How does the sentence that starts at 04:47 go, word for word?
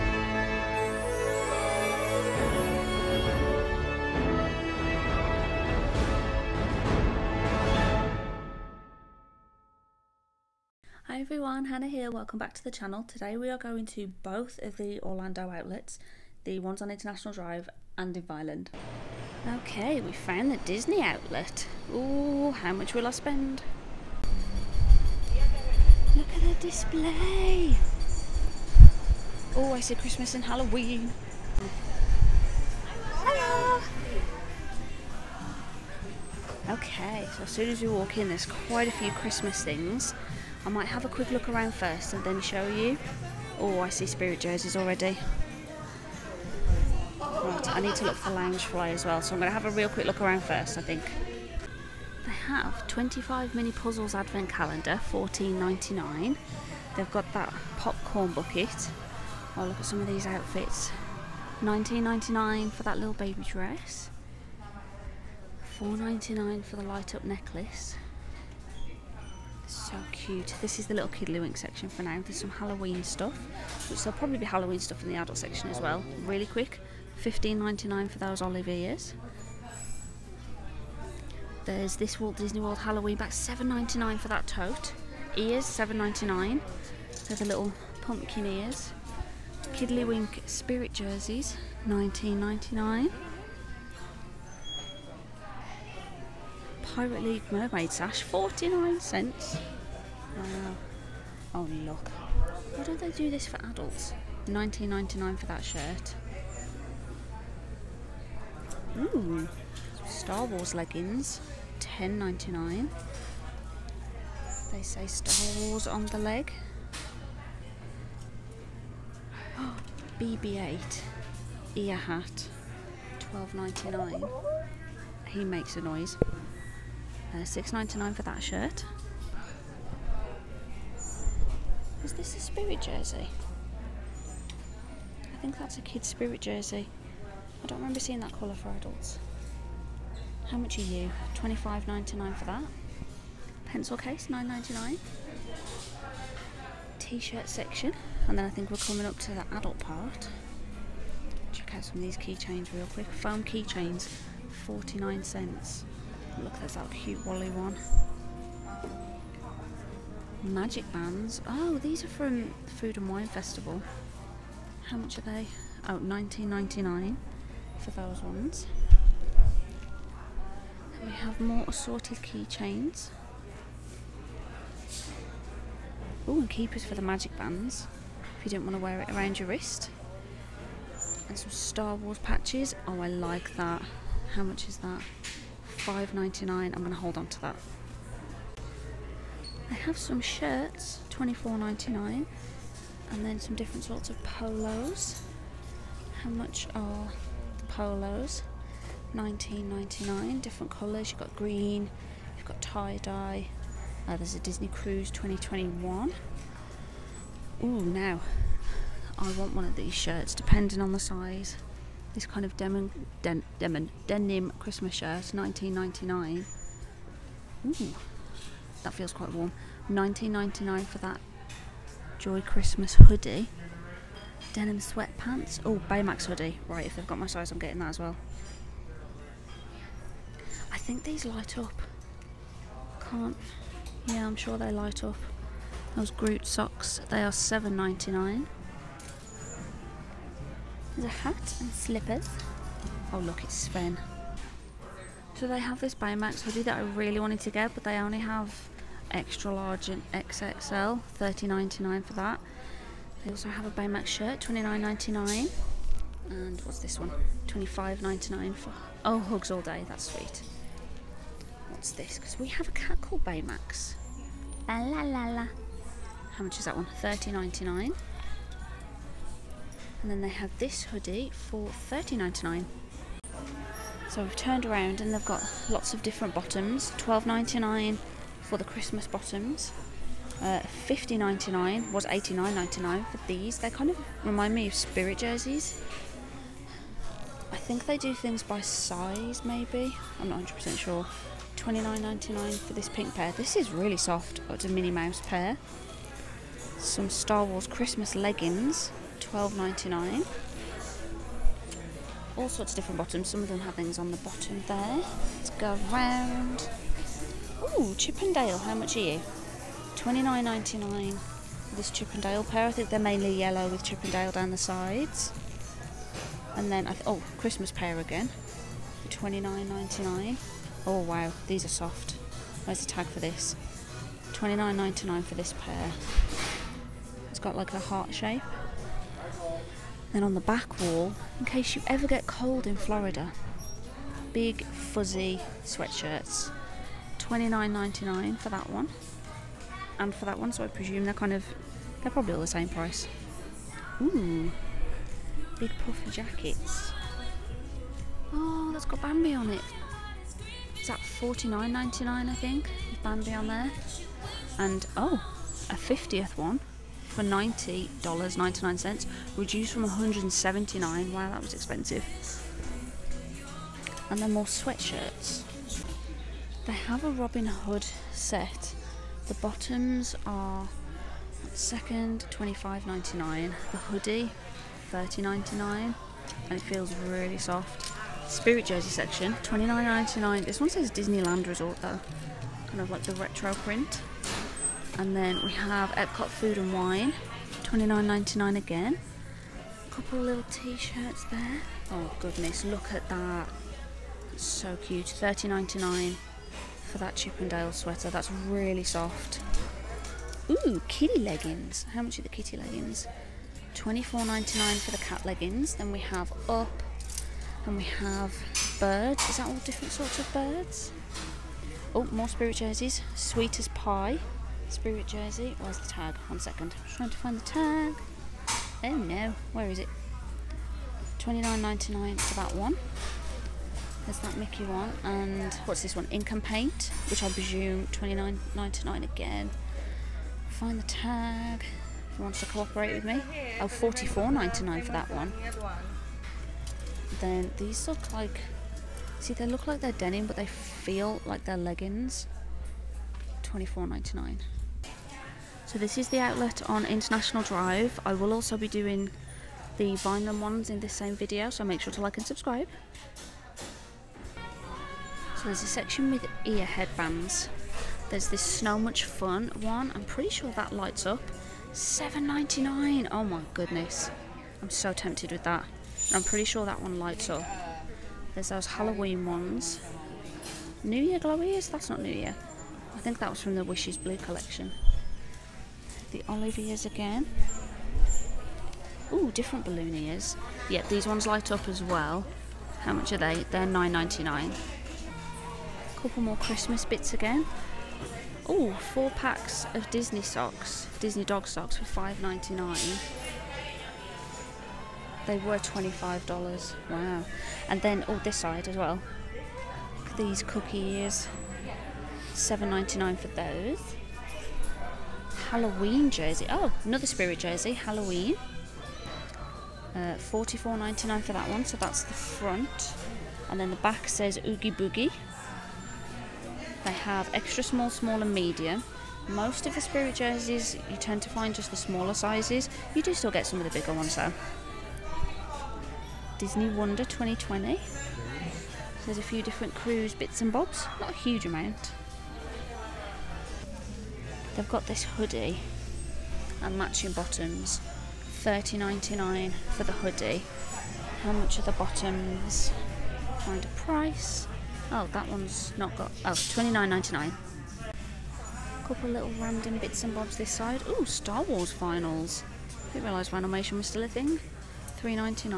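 I think they do things by size, maybe.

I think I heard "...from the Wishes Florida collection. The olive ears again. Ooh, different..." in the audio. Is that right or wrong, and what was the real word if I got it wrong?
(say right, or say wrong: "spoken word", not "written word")
wrong: "Blue", not "Florida".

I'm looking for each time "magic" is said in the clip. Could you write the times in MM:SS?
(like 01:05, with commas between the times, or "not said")
02:40, 02:57.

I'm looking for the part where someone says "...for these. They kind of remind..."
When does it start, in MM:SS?
04:43.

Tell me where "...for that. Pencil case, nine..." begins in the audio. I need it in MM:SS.
02:22.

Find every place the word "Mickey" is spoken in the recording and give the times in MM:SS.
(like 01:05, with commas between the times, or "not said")
07:04.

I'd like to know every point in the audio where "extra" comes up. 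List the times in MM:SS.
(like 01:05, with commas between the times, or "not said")
04:09, 08:37.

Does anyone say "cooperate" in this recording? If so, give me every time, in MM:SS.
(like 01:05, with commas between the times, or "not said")
07:12.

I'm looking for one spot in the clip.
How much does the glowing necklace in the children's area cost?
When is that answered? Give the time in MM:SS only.
01:05.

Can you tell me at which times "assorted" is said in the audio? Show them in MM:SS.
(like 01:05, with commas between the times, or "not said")
02:51.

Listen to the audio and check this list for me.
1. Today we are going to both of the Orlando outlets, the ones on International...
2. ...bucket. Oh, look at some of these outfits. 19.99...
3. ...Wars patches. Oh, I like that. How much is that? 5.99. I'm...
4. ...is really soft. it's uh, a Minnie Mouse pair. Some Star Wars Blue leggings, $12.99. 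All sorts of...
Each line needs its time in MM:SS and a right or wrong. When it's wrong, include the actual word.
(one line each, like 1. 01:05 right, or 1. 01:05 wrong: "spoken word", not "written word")
1. 00:13 right
2. 00:58 right
3. 03:01 right
4. 04:53 wrong: "Christmas", not "Blue".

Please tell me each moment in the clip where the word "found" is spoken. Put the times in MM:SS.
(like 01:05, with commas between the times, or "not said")
00:20.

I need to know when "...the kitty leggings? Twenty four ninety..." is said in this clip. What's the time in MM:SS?
06:42.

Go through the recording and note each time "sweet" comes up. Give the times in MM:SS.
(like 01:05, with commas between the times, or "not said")
04:20, 06:53.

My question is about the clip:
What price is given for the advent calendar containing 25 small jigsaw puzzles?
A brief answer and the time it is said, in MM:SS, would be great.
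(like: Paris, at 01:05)
$14.99, at 00:55.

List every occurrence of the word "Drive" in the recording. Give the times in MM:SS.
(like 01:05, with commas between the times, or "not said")
00:17, 07:27.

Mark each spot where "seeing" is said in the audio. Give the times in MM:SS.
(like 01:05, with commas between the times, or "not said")
02:17.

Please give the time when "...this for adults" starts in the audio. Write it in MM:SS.
01:43.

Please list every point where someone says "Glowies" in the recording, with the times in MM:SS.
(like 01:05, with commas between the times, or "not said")
07:51.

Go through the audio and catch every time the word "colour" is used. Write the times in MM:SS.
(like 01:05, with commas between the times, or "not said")
02:18, 03:20.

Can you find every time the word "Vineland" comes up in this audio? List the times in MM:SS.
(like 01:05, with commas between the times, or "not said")
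00:18, 07:29.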